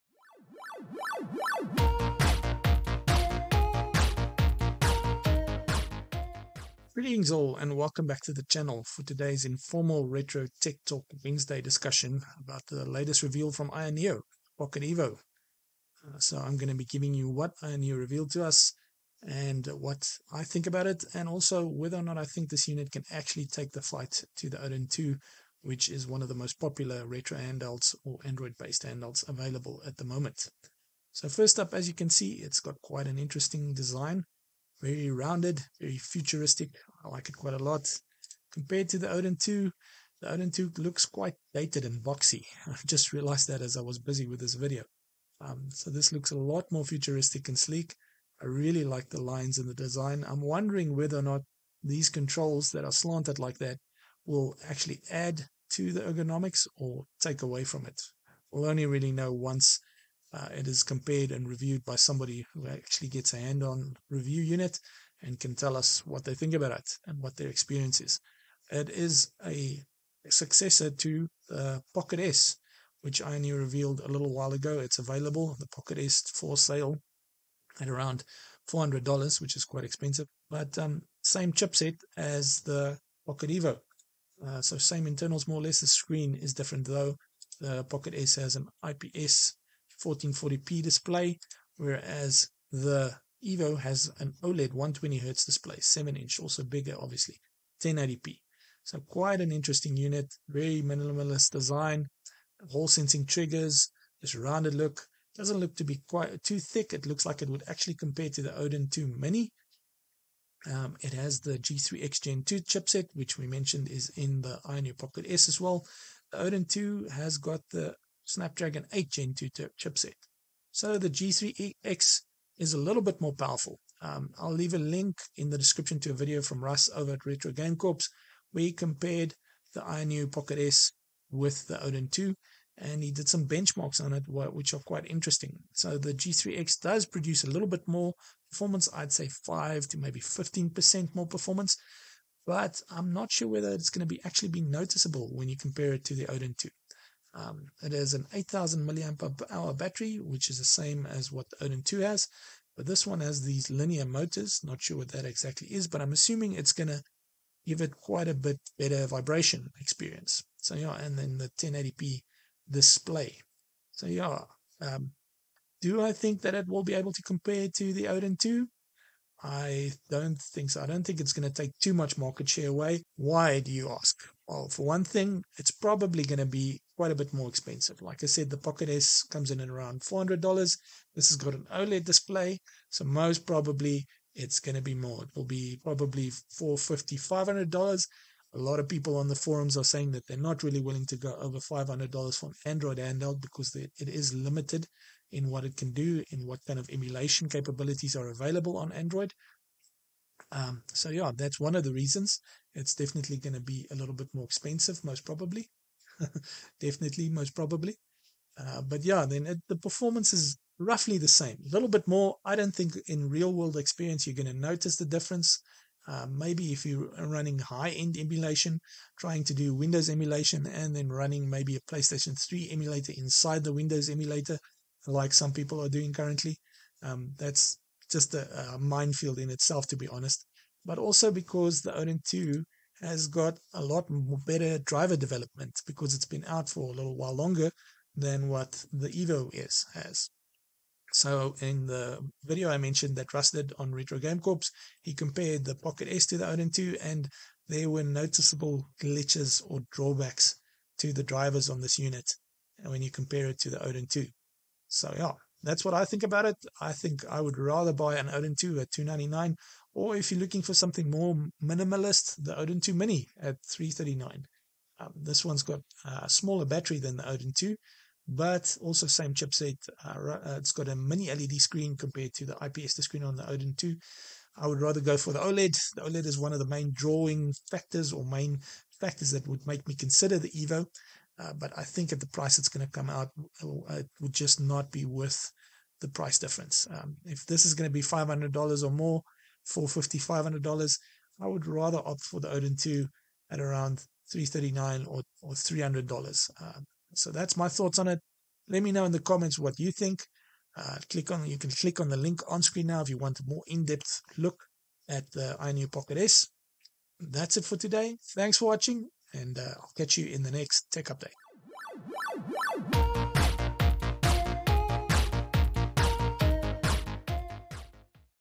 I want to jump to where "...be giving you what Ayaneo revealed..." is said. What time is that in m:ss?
0:16.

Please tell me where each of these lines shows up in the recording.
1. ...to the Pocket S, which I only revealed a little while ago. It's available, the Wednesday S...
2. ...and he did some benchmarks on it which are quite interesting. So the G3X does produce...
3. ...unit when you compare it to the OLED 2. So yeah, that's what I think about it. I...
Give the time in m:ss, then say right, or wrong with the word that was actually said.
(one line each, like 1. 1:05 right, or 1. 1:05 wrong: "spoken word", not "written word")
1. 1:10 wrong: "Pocket", not "Wednesday"
2. 2:12 right
3. 4:11 wrong: "Odin", not "OLED".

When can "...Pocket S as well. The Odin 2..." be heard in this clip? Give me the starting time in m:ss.
1:54.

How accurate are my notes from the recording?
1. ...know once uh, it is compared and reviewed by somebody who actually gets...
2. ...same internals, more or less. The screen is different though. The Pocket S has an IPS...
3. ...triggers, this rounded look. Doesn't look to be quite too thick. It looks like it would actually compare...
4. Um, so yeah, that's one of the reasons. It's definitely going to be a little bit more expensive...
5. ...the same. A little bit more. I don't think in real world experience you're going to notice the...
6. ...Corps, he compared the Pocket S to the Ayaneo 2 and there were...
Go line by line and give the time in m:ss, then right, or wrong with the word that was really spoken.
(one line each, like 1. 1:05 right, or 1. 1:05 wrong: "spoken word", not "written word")
1. 0:59 right
2. 1:24 right
3. 1:43 right
4. 3:20 right
5. 3:31 right
6. 4:04 wrong: "Odin", not "Ayaneo".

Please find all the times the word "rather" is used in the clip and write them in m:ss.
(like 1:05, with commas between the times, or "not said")
4:17, 4:34, 4:51.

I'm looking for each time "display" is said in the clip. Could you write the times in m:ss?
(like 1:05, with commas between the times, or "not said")
1:30, 1:35, 2:42, 3:02.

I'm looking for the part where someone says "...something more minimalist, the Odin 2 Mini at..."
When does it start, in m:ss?
4:20.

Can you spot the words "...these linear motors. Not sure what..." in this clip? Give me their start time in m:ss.
2:33.